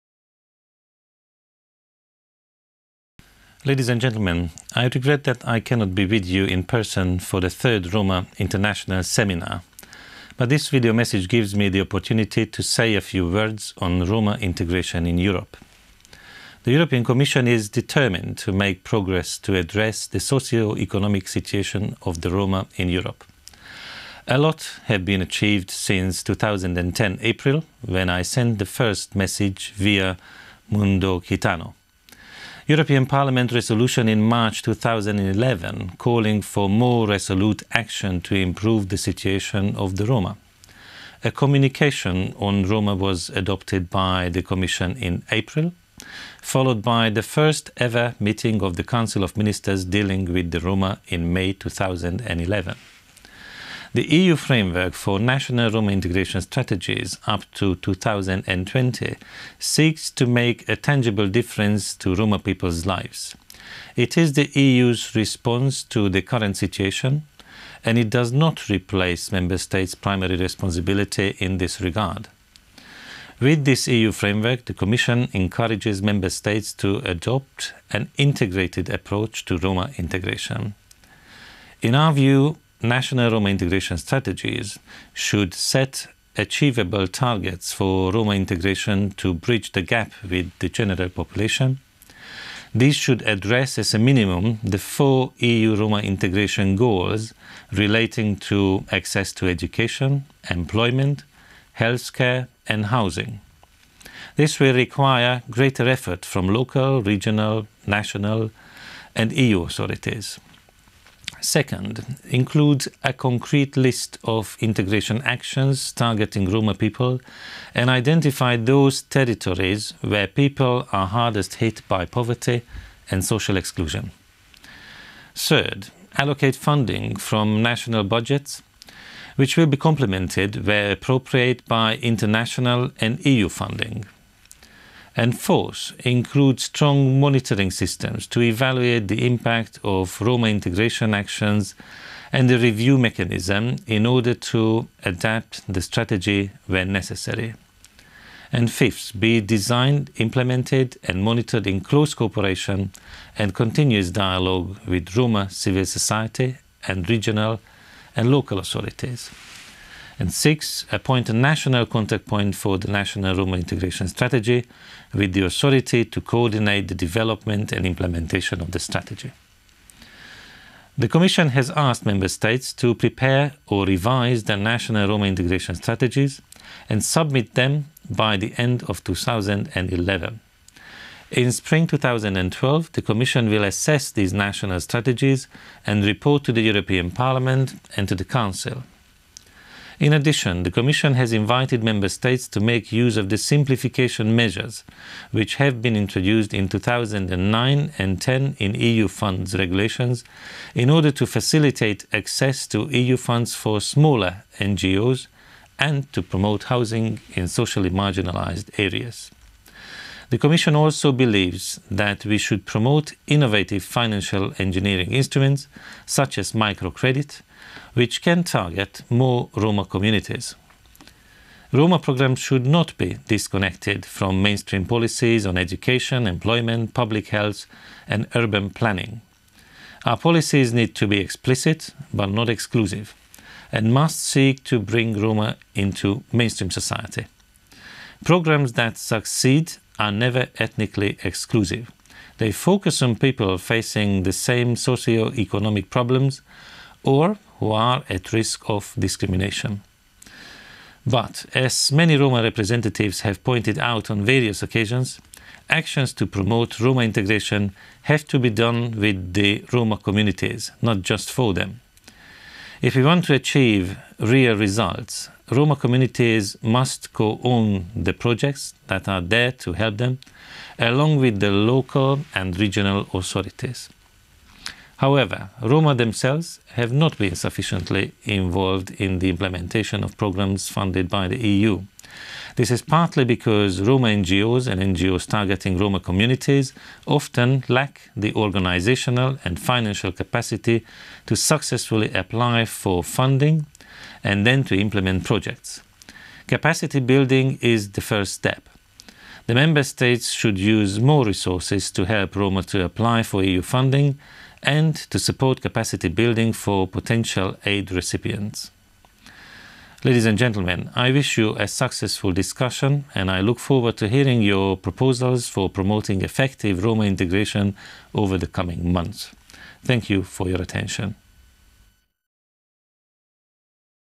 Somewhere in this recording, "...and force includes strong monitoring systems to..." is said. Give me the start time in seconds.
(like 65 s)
135 s.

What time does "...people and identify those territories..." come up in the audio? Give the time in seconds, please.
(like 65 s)
116 s.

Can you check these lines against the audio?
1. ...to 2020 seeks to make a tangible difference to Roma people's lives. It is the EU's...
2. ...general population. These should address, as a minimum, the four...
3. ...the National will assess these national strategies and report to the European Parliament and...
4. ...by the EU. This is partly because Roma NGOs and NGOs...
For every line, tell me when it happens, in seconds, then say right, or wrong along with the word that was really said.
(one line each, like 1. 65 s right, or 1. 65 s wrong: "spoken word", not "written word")
1. 57 s right
2. 90 s right
3. 182 s wrong: "Commission", not "National"
4. 281 s right.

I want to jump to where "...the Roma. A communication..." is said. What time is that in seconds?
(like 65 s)
39 s.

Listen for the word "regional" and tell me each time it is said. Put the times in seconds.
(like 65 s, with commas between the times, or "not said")
107 s, 157 s, 272 s.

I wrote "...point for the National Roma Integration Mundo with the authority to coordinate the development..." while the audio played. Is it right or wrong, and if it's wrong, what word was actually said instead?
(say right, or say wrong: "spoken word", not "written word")
wrong: "Strategy", not "Mundo".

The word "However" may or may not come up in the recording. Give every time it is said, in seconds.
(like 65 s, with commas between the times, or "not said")
274 s.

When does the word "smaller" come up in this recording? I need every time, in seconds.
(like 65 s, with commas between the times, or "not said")
203 s.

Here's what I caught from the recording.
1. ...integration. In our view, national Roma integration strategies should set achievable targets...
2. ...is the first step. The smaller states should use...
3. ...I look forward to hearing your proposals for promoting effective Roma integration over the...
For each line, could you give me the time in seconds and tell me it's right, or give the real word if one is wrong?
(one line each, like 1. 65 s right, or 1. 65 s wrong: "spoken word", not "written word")
1. 79 s right
2. 297 s wrong: "member", not "smaller"
3. 313 s right.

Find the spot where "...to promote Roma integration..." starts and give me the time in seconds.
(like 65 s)
256 s.